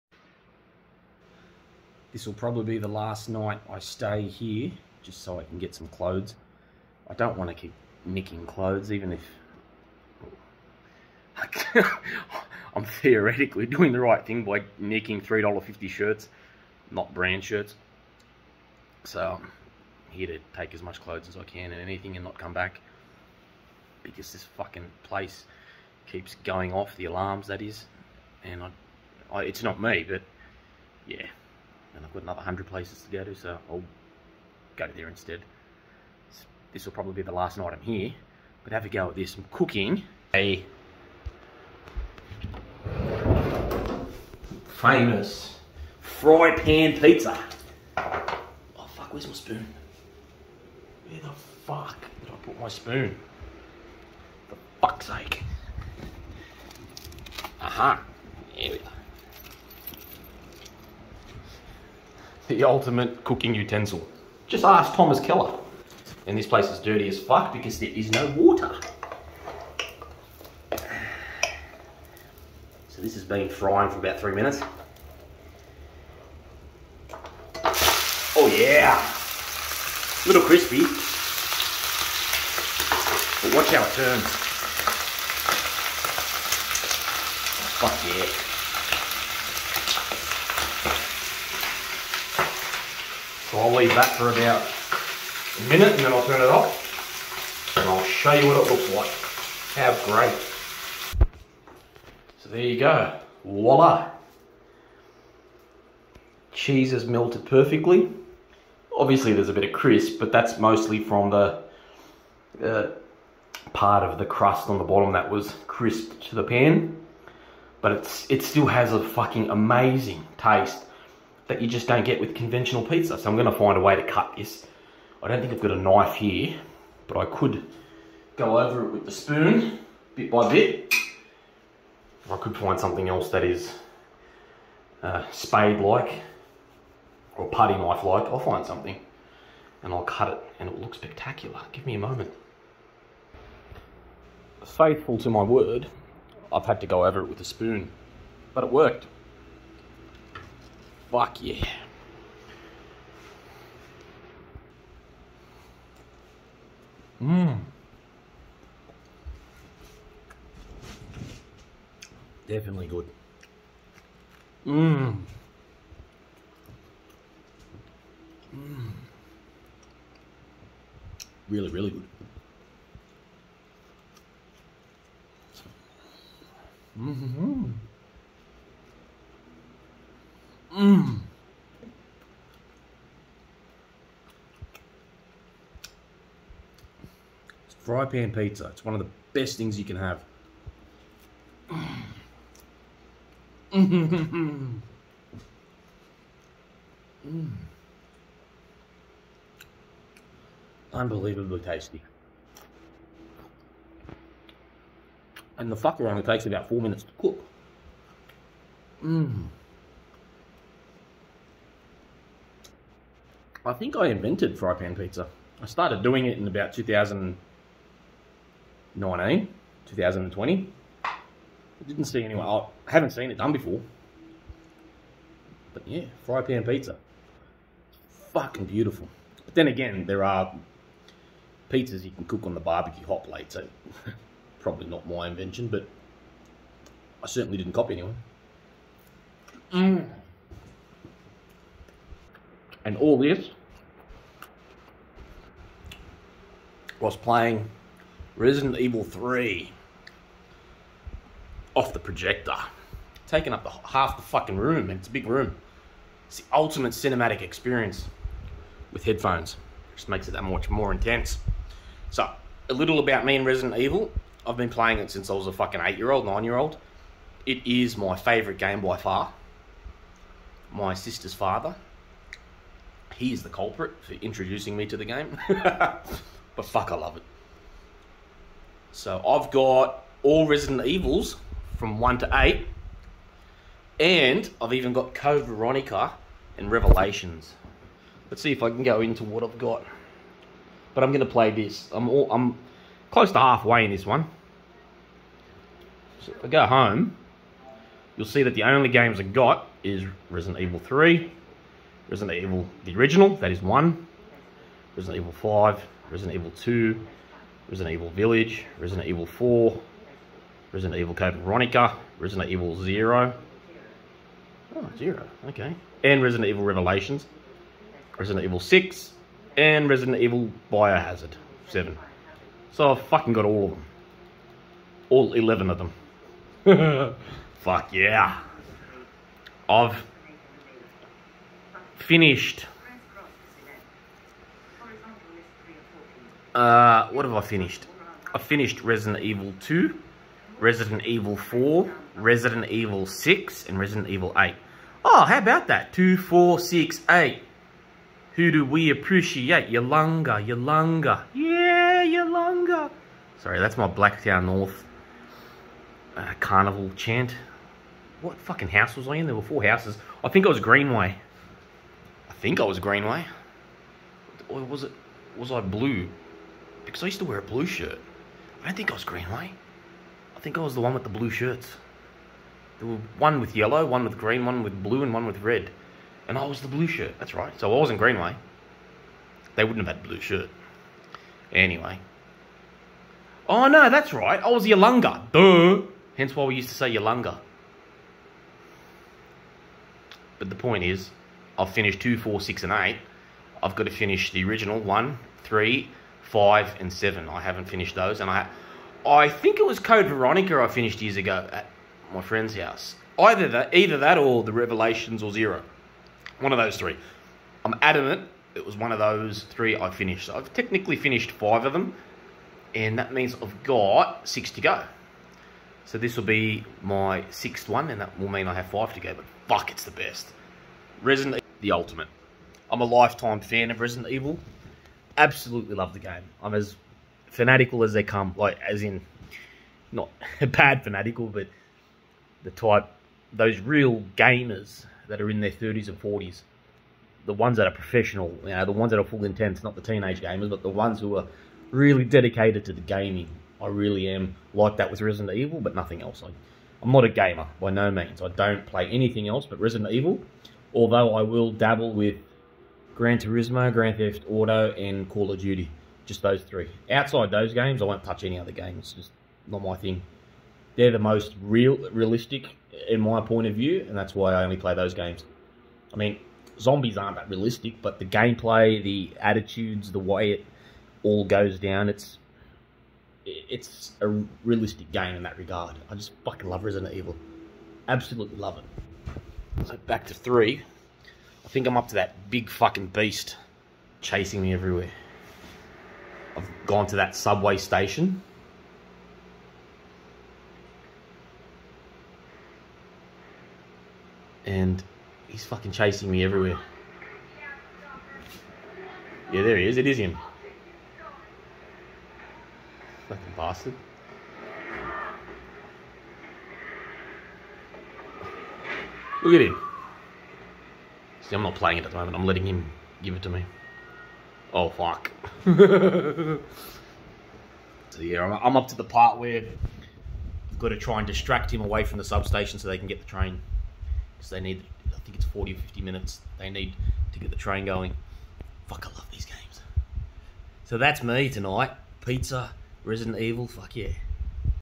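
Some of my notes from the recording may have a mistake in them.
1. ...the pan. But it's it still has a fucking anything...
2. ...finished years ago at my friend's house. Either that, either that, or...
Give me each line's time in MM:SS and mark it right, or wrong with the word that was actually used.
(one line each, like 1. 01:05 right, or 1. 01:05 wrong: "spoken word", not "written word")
1. 01:56 wrong: "amazing", not "anything"
2. 06:40 right.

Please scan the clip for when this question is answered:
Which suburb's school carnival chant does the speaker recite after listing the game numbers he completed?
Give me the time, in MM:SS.
05:53.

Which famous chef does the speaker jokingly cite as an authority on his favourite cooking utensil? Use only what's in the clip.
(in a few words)
Thomas Keller.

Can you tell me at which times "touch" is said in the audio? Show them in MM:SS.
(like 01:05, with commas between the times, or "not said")
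07:38.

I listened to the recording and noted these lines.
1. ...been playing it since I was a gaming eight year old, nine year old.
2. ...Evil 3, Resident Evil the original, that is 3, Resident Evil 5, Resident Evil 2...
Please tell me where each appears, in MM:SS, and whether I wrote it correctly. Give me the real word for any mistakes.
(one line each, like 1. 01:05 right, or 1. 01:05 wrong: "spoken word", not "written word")
1. 04:24 wrong: "fucking", not "gaming"
2. 05:00 wrong: "1", not "3".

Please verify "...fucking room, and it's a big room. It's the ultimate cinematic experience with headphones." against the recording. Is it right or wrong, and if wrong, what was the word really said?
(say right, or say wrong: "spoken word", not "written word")
right.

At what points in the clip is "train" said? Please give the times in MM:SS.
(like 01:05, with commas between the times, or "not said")
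08:43, 08:47.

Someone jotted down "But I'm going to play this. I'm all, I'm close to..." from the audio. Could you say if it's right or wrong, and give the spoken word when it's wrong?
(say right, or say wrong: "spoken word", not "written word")
right.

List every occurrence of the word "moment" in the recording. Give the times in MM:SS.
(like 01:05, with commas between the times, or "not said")
02:21, 08:31.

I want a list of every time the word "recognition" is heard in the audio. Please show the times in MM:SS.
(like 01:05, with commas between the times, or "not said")
not said.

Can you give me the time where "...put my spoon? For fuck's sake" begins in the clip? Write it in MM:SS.
00:52.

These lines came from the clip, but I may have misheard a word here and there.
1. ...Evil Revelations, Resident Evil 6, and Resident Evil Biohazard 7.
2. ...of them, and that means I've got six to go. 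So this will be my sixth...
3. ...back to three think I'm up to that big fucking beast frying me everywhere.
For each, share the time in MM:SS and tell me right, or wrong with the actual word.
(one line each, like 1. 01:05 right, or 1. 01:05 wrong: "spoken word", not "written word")
1. 05:16 right
2. 06:51 right
3. 07:59 wrong: "chasing", not "frying".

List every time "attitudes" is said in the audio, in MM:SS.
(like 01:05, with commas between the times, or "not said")
07:49.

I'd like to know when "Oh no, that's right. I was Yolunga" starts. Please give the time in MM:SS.
06:23.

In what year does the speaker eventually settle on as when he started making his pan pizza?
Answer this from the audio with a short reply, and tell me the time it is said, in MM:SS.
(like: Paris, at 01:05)
2020, at 03:39.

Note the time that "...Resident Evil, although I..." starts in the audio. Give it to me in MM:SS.
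07:29.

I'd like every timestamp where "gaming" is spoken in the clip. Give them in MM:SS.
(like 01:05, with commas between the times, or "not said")
07:22.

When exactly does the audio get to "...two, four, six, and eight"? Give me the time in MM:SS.
06:31.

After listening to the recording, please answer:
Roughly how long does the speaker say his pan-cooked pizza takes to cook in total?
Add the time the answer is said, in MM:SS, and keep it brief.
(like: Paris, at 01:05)
About 4 minutes, at 03:26.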